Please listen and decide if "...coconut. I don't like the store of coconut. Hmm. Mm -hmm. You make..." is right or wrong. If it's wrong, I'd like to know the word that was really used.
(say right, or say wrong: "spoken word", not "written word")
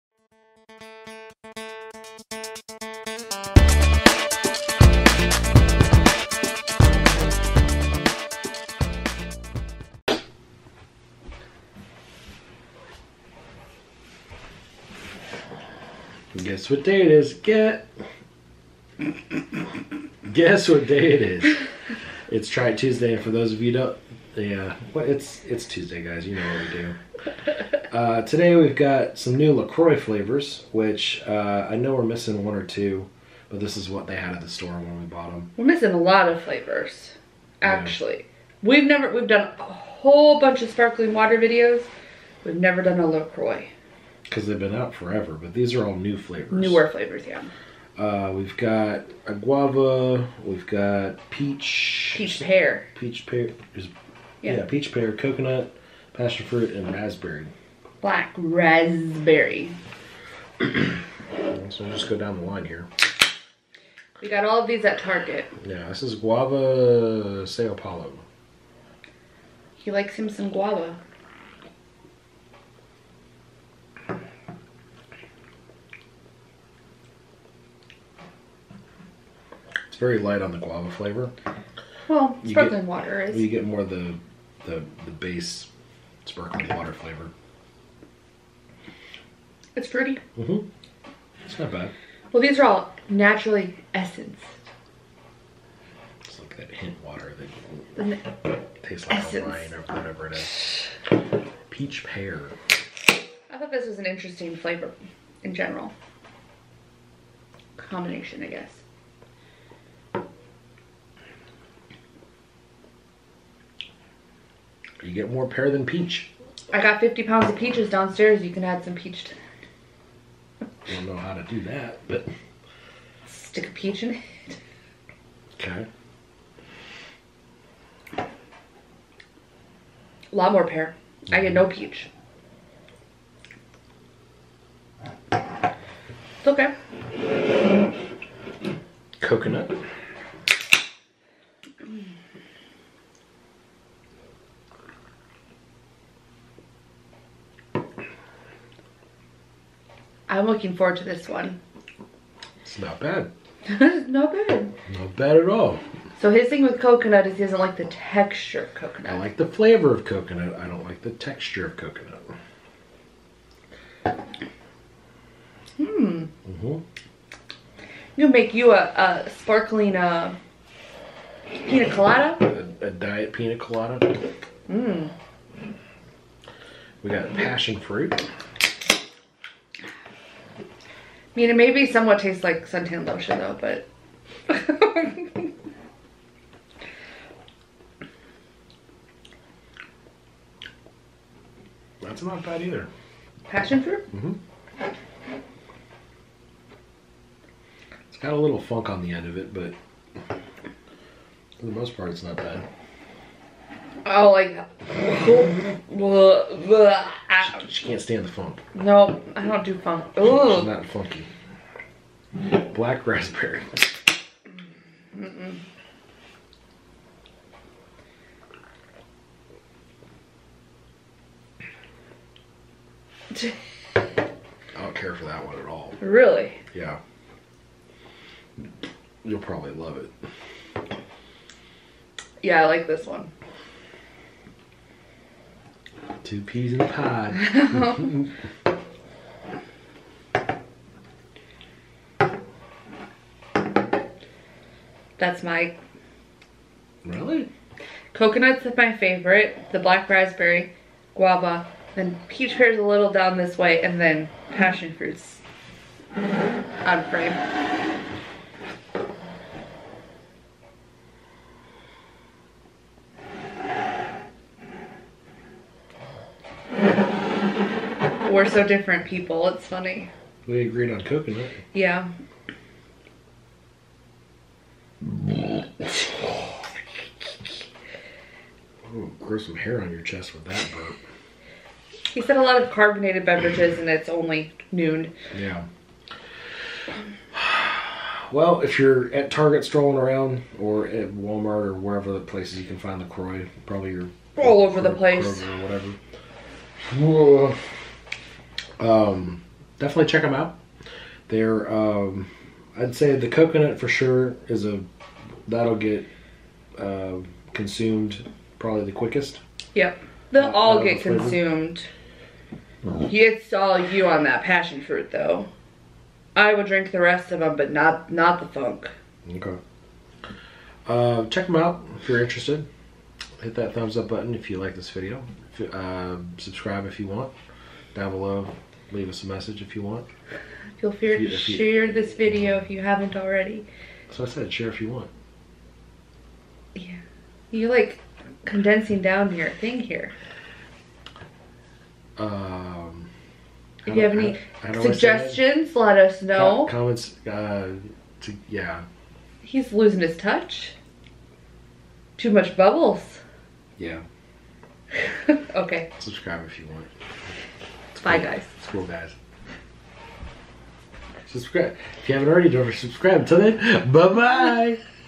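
wrong: "texture", not "store".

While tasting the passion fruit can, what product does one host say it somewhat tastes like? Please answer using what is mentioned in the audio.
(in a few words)
suntan lotion.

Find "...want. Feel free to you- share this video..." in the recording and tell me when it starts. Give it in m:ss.
5:29.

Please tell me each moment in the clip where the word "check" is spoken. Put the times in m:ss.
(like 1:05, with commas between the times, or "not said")
5:00, 5:21.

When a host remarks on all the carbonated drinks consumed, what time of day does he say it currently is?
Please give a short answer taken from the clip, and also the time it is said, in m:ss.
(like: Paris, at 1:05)
noon, at 4:43.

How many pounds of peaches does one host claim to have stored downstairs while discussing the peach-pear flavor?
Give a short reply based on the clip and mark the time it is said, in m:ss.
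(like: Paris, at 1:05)
50, at 1:57.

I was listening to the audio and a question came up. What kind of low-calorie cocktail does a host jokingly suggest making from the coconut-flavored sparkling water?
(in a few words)
diet pina colada.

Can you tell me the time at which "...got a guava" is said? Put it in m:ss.
0:48.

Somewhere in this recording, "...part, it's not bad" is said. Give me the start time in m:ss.
3:21.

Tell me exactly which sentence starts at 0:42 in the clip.
We've never done a Lacroix because they've been out forever.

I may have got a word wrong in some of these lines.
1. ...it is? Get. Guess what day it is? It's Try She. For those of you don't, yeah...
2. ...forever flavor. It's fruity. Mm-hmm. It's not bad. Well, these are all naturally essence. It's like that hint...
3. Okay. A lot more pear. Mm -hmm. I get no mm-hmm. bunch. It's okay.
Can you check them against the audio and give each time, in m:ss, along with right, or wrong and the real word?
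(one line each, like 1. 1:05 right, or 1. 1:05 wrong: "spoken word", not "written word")
1. 0:17 wrong: "Tuesday", not "She"
2. 1:26 wrong: "water", not "forever"
3. 2:05 wrong: "peach", not "bunch".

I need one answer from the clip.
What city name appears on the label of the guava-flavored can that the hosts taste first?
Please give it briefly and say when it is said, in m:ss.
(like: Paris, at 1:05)
Sao Paulo, at 1:06.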